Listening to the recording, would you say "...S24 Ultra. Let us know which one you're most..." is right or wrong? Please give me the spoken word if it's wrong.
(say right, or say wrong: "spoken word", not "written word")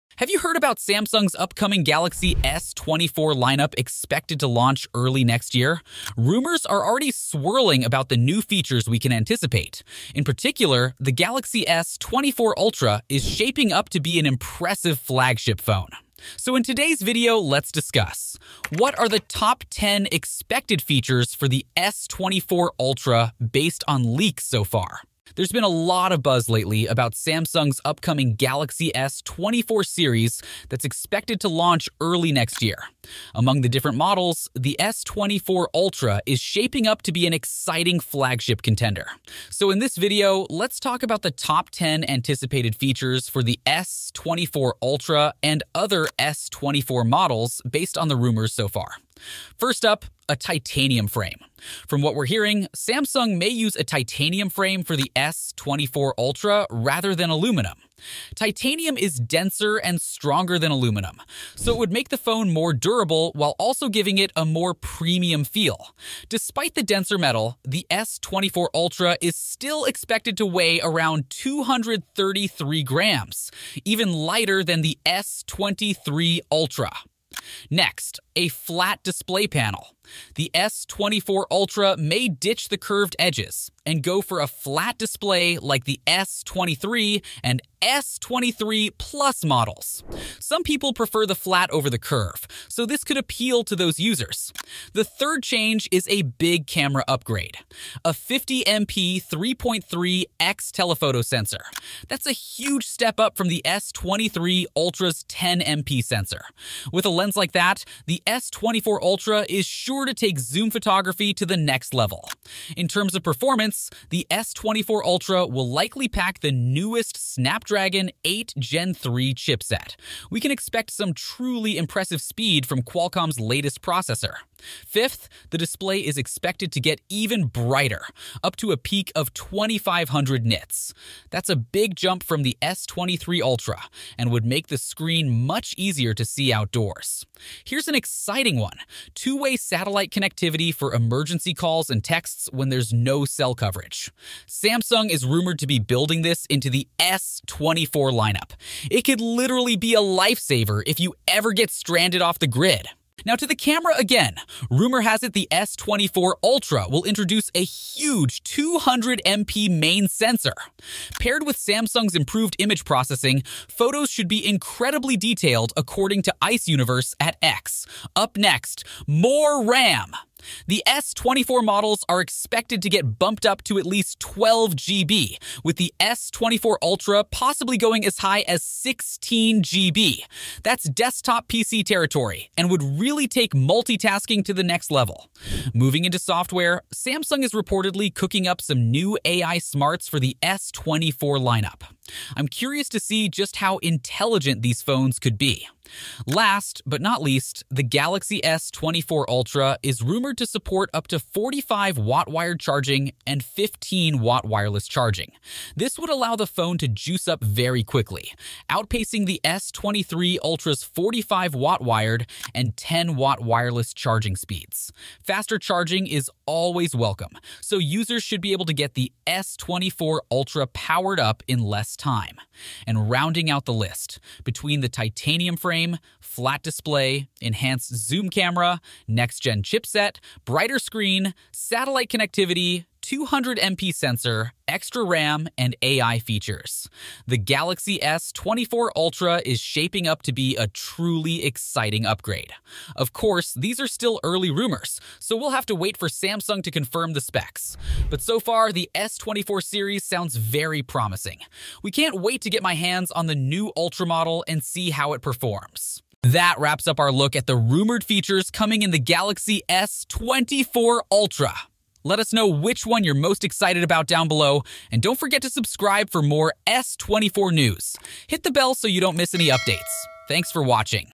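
right.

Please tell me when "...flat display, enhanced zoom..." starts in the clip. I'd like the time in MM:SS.
03:46.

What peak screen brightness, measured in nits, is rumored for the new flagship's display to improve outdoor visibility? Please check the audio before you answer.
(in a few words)
2500 nits.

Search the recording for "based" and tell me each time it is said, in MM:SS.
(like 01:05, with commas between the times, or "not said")
00:23, 00:47.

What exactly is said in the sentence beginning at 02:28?
It could literally be a lifesaver if you ever get stranded off the grid.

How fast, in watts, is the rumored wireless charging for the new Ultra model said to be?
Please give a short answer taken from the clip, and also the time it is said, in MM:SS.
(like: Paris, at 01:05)
15 watts, at 03:23.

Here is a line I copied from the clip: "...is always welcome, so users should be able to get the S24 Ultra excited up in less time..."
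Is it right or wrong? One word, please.
wrong.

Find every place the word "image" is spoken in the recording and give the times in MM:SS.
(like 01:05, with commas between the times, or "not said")
02:42.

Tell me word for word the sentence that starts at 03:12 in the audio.
I'm curious to see just how intelligent these phones could be.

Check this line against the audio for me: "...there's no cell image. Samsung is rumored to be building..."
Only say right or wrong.
wrong.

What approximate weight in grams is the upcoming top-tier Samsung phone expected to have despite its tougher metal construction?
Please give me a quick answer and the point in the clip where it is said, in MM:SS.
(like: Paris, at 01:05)
233 grams, at 01:11.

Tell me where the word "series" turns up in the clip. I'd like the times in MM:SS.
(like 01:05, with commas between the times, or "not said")
00:29, 04:09.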